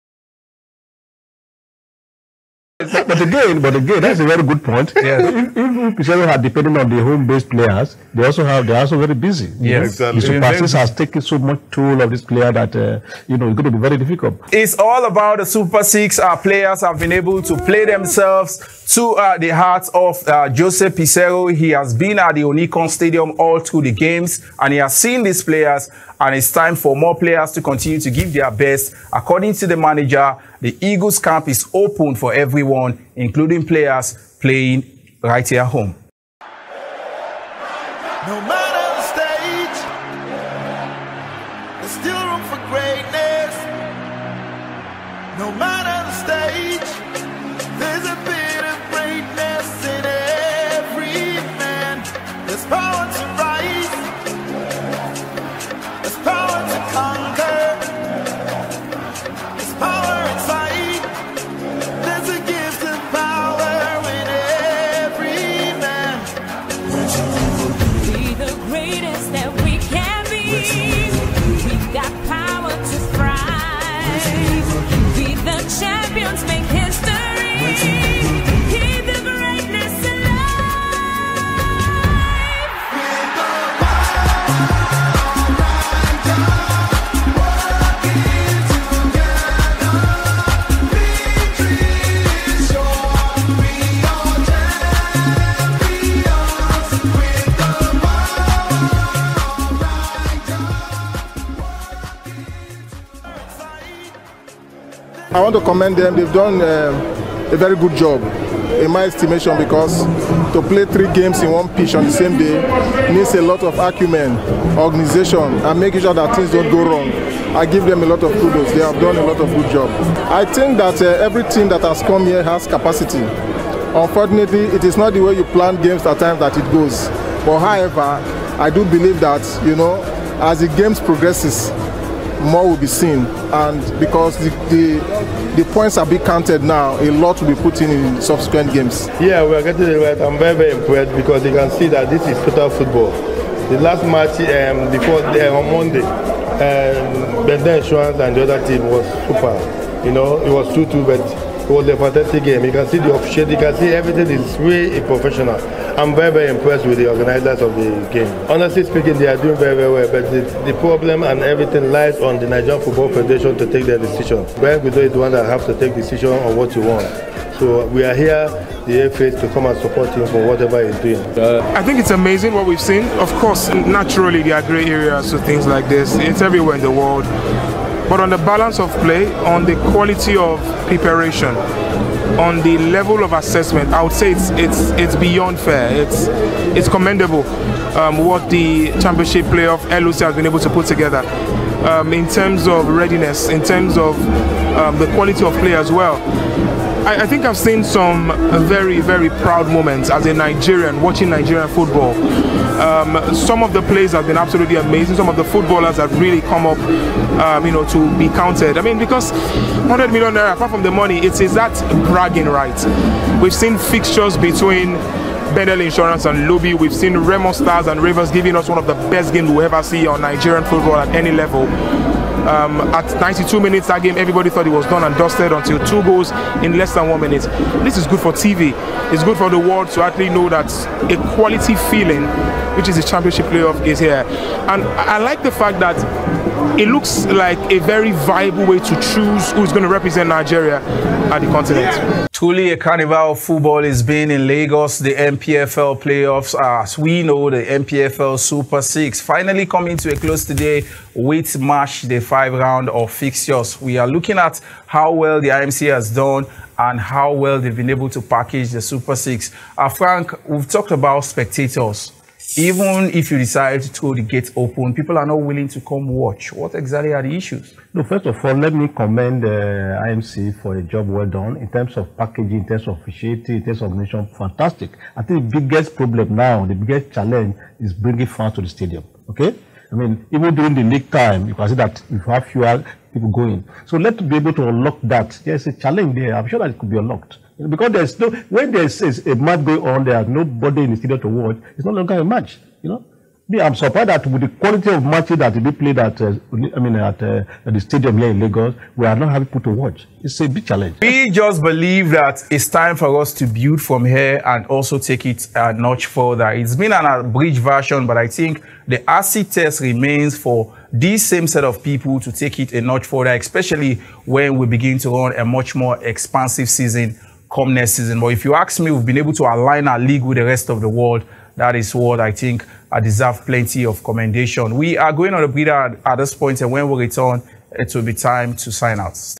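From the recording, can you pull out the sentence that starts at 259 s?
Uh, Frank, we've talked about spectators.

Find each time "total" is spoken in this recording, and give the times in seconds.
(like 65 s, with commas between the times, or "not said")
142 s.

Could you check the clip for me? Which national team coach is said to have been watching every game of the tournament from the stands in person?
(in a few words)
Jose Peseiro.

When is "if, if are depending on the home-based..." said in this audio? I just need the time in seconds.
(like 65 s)
5 s.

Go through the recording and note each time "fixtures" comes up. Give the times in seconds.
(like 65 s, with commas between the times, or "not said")
213 s, 253 s.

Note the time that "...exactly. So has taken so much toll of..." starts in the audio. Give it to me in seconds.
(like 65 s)
10 s.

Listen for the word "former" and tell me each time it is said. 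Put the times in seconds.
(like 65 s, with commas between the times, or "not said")
not said.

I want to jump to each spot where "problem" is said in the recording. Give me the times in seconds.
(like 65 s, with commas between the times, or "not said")
160 s, 275 s.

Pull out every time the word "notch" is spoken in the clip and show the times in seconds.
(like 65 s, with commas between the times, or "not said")
305 s, 312 s.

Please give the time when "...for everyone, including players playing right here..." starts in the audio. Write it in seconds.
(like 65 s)
32 s.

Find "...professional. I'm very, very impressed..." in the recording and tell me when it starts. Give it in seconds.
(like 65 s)
155 s.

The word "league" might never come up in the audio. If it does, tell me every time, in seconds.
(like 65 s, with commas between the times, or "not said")
280 s, 319 s.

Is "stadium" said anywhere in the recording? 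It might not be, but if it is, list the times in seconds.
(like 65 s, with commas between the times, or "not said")
22 s, 278 s, 290 s, 297 s.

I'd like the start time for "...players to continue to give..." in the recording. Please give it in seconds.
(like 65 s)
27 s.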